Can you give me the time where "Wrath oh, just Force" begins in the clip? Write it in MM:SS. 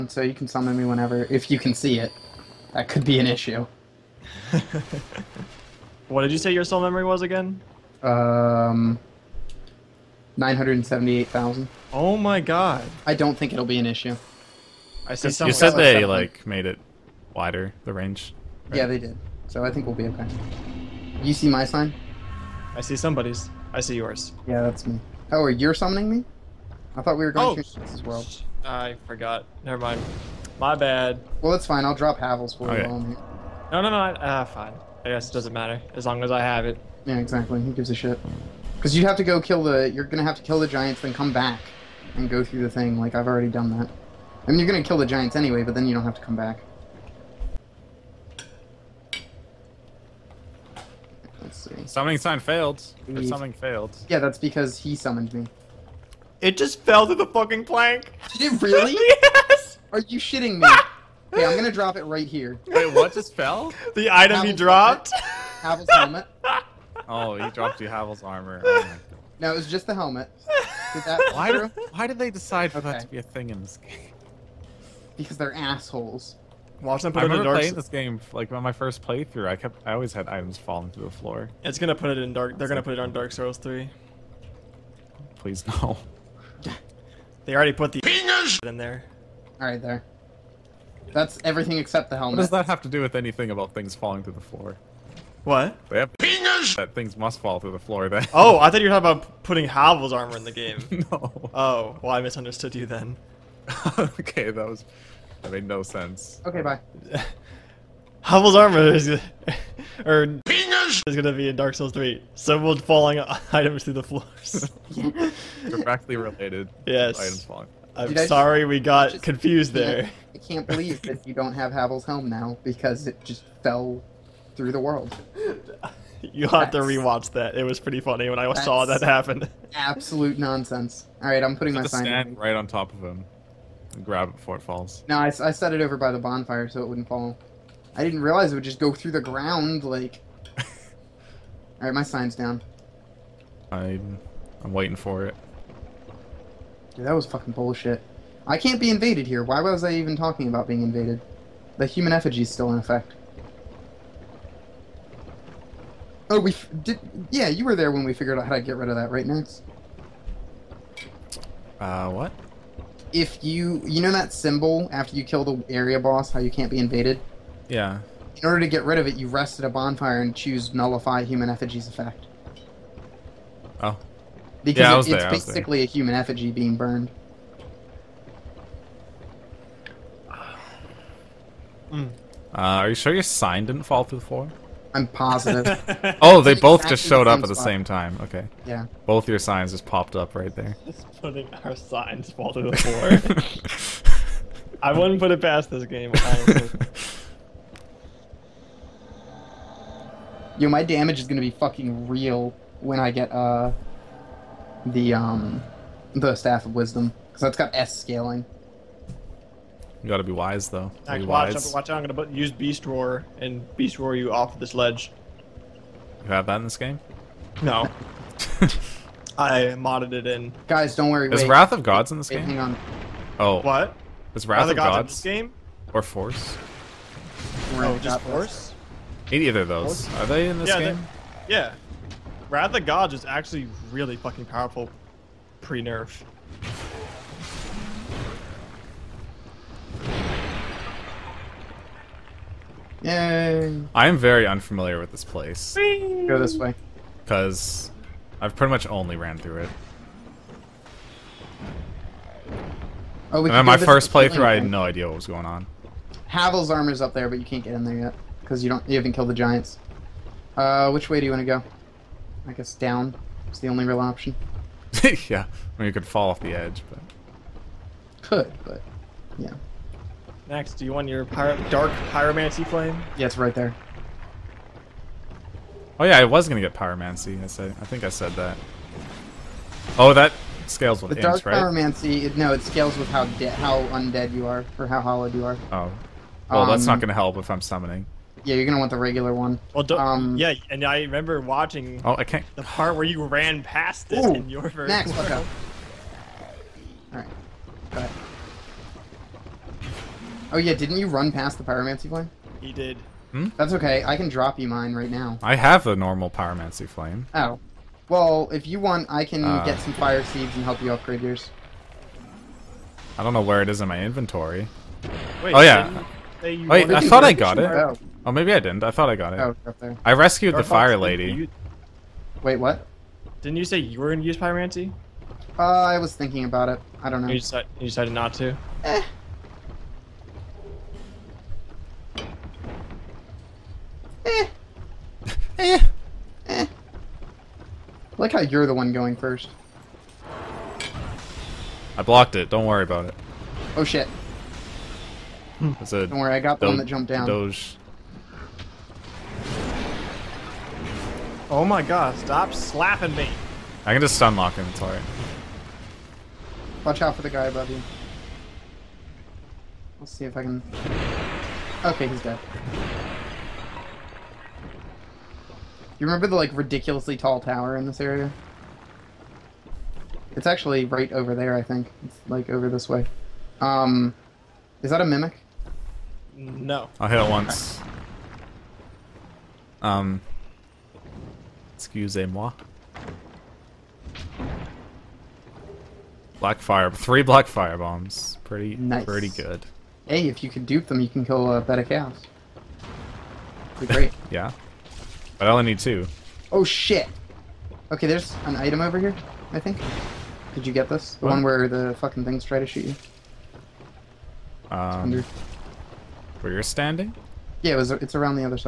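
03:47.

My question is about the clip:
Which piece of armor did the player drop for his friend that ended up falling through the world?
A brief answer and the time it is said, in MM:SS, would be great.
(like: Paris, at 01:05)
Havel's helmet, at 01:05.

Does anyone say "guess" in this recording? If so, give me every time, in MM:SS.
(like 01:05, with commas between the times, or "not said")
00:35, 04:22.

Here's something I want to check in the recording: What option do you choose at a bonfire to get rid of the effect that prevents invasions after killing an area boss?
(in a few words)
nullify human effigy's effect.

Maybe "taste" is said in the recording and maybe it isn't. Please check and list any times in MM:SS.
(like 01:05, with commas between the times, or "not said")
not said.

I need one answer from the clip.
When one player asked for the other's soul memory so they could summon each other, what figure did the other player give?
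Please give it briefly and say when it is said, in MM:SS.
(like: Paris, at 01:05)
978,000, at 00:10.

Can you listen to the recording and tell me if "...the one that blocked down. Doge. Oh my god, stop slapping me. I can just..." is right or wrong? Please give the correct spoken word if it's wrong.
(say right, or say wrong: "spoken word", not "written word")
wrong: "jumped", not "blocked".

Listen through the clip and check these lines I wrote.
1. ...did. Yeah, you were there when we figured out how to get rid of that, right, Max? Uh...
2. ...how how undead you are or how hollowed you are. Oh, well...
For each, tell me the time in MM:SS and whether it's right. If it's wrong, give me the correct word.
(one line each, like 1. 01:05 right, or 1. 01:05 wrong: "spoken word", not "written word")
1. 02:36 right
2. 04:43 right.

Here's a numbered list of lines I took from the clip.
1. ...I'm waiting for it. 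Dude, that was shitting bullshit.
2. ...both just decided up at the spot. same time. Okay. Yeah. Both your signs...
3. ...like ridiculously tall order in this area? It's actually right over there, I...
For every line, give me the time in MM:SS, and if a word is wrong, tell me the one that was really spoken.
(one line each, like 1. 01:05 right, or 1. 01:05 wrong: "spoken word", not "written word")
1. 02:24 wrong: "fucking", not "shitting"
2. 03:06 wrong: "showed", not "decided"
3. 06:06 wrong: "tower", not "order".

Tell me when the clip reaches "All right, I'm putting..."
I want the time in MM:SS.
02:11.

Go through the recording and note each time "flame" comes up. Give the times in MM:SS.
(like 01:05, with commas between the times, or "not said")
04:32, 05:02, 05:06.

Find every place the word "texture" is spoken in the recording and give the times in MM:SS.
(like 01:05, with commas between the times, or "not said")
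not said.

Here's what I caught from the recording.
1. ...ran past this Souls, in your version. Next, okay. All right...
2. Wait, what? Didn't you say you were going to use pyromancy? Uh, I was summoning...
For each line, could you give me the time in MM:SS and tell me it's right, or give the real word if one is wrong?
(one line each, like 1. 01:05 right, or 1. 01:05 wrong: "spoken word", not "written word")
1. 04:53 wrong: "Ooh", not "Souls"
2. 05:22 wrong: "thinking", not "summoning".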